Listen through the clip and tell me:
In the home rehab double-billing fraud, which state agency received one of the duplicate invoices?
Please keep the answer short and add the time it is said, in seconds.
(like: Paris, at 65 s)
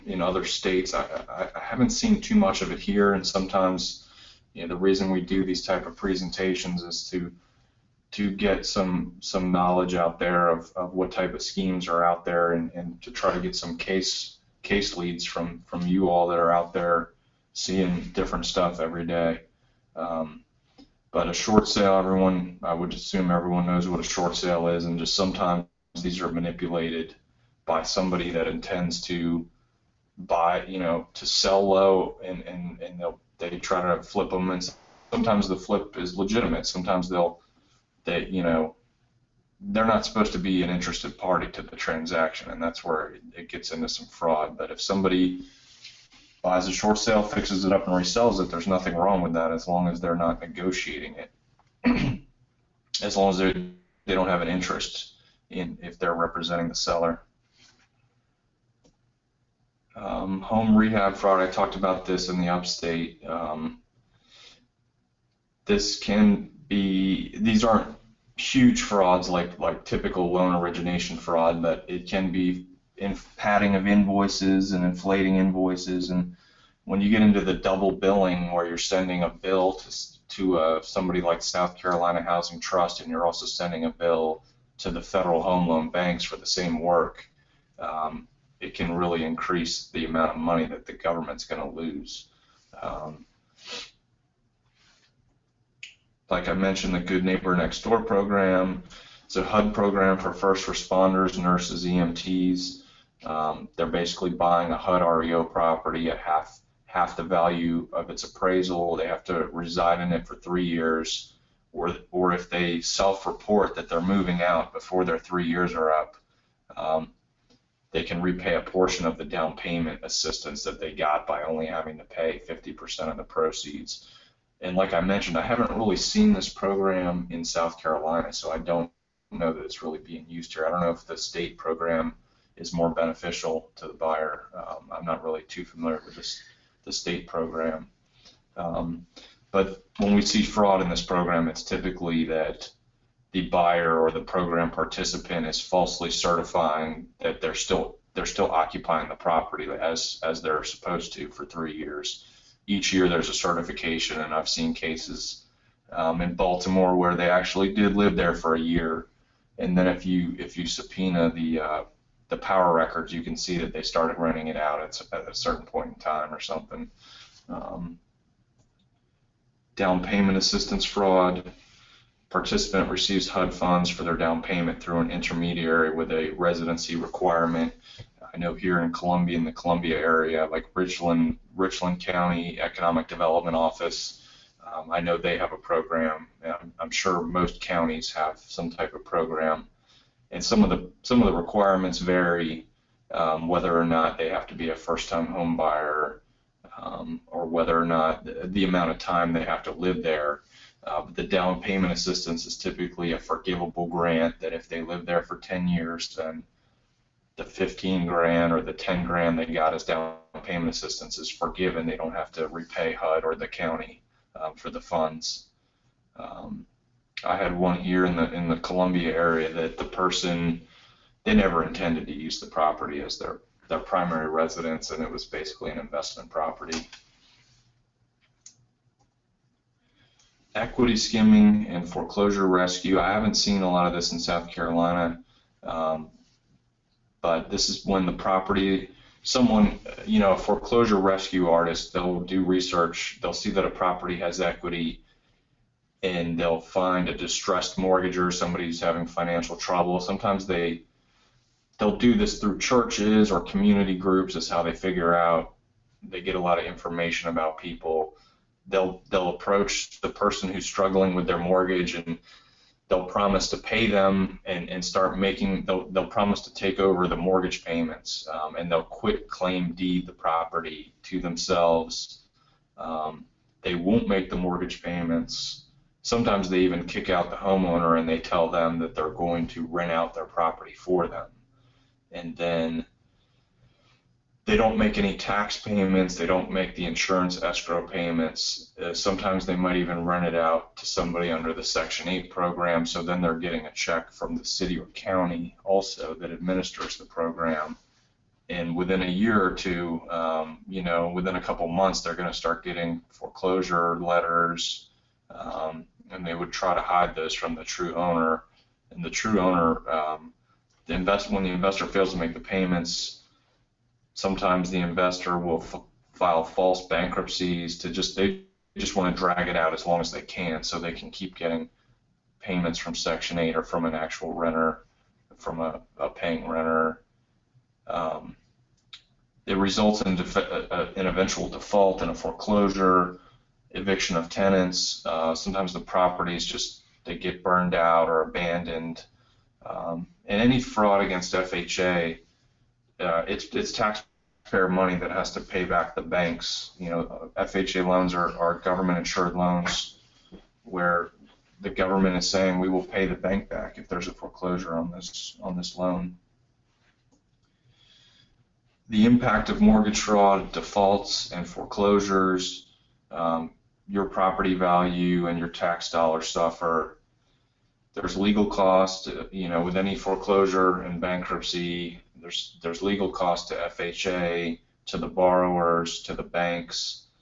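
South Carolina Housing Trust, at 81 s.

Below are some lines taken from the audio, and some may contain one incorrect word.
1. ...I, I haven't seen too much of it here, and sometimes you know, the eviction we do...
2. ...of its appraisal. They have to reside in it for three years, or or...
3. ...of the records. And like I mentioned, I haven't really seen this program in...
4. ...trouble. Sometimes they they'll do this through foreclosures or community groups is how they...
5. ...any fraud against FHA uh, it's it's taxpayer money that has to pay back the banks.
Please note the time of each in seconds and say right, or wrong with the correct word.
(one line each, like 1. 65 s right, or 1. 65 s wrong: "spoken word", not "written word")
1. 1 s wrong: "reason", not "eviction"
2. 107 s right
3. 123 s wrong: "proceeds", not "records"
4. 249 s wrong: "churches", not "foreclosures"
5. 340 s right.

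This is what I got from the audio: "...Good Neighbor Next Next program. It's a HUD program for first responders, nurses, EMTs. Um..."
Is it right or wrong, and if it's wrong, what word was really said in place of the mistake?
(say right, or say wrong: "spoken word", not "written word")
wrong: "Door", not "Next".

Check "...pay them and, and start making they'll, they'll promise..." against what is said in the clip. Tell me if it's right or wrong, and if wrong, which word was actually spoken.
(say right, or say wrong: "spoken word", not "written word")
right.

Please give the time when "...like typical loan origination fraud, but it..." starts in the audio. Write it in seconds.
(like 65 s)
69 s.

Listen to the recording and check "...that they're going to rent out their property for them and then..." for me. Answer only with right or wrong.
right.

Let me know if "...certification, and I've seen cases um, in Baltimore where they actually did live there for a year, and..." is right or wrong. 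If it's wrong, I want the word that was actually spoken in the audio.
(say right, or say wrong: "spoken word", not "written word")
right.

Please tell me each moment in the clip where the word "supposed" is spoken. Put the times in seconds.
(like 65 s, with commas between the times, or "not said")
40 s, 150 s.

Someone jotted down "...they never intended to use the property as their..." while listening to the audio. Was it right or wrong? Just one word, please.
right.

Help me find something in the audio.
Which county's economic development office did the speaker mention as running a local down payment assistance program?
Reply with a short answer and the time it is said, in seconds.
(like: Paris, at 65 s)
Richland County, at 181 s.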